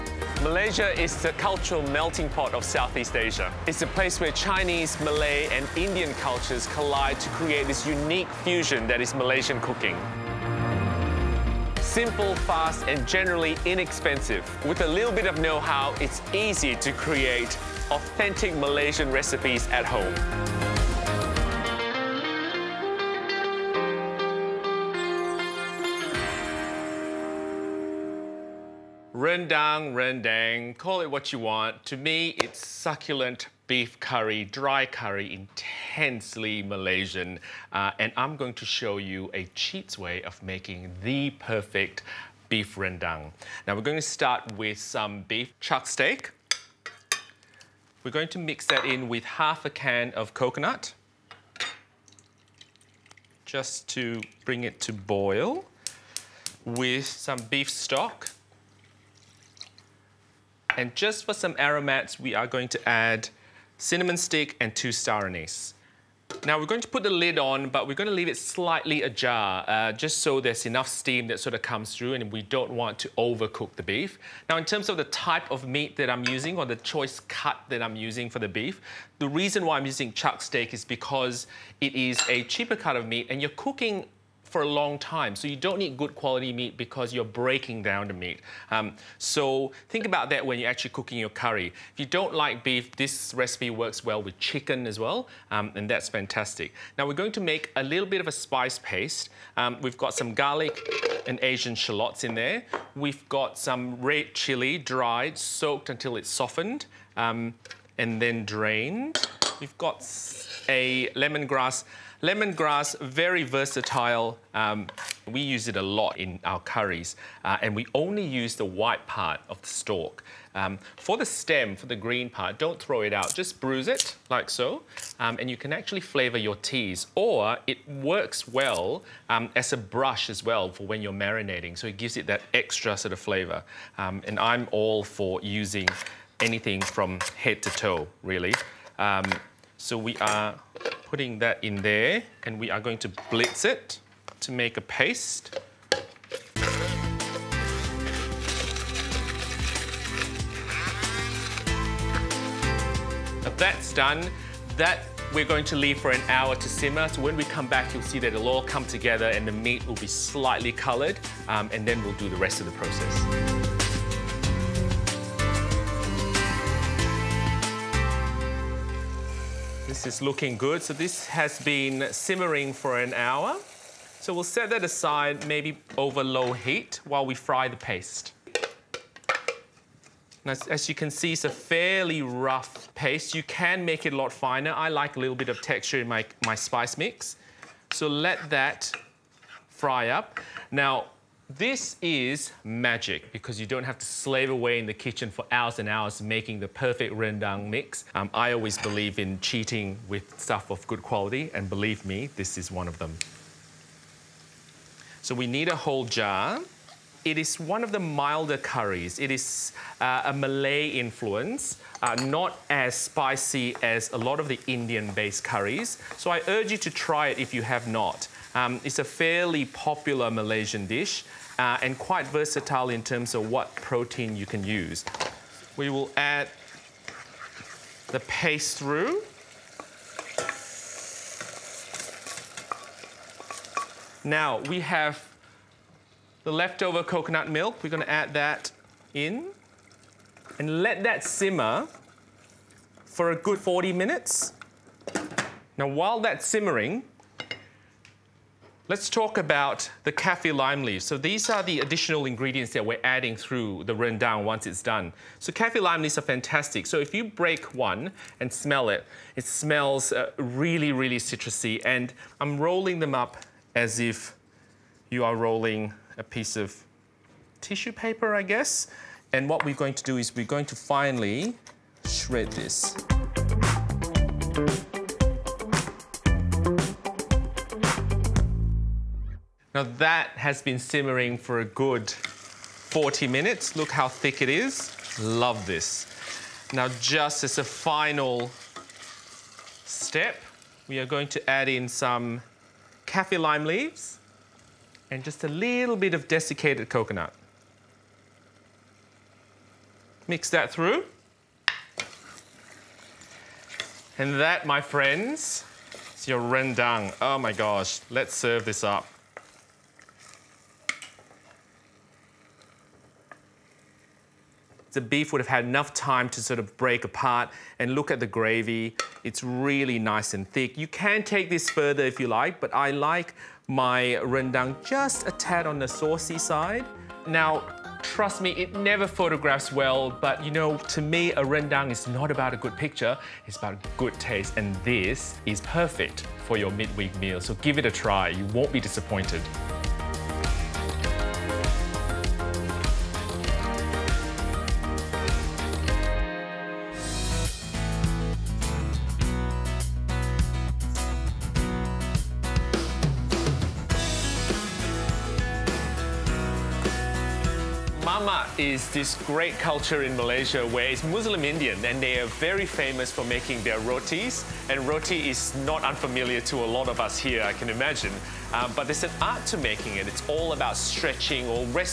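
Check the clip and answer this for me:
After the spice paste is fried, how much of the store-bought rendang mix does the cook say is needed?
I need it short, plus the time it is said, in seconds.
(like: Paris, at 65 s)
a whole jar, at 205 s.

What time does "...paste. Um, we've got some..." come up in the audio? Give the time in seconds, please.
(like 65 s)
98 s.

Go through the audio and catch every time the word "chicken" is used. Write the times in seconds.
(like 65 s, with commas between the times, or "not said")
94 s.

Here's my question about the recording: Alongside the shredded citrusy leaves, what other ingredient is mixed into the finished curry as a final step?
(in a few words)
desiccated coconut.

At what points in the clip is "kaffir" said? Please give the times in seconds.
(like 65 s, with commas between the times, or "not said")
250 s, 255 s, 293 s.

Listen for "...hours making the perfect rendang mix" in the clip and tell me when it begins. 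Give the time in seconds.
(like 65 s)
195 s.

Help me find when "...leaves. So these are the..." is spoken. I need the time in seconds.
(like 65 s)
250 s.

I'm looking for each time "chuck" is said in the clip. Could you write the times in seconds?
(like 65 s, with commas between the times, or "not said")
45 s, 80 s.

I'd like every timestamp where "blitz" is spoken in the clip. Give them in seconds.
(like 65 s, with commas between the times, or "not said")
143 s.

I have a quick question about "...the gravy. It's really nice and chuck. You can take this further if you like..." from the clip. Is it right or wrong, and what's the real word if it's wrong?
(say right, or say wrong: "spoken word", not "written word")
wrong: "thick", not "chuck".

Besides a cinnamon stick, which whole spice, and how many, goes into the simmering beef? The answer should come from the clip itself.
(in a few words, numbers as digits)
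2 star anise.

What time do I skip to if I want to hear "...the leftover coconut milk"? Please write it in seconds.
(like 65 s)
236 s.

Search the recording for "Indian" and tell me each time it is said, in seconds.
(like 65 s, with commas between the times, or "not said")
5 s, 214 s, 361 s.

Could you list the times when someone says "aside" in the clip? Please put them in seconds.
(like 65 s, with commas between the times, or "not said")
174 s.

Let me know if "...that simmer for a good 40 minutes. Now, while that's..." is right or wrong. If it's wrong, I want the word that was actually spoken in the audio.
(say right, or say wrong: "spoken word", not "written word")
right.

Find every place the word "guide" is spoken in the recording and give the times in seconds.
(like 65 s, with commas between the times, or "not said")
not said.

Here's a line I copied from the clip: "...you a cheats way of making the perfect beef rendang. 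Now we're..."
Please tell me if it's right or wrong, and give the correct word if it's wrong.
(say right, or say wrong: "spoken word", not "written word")
right.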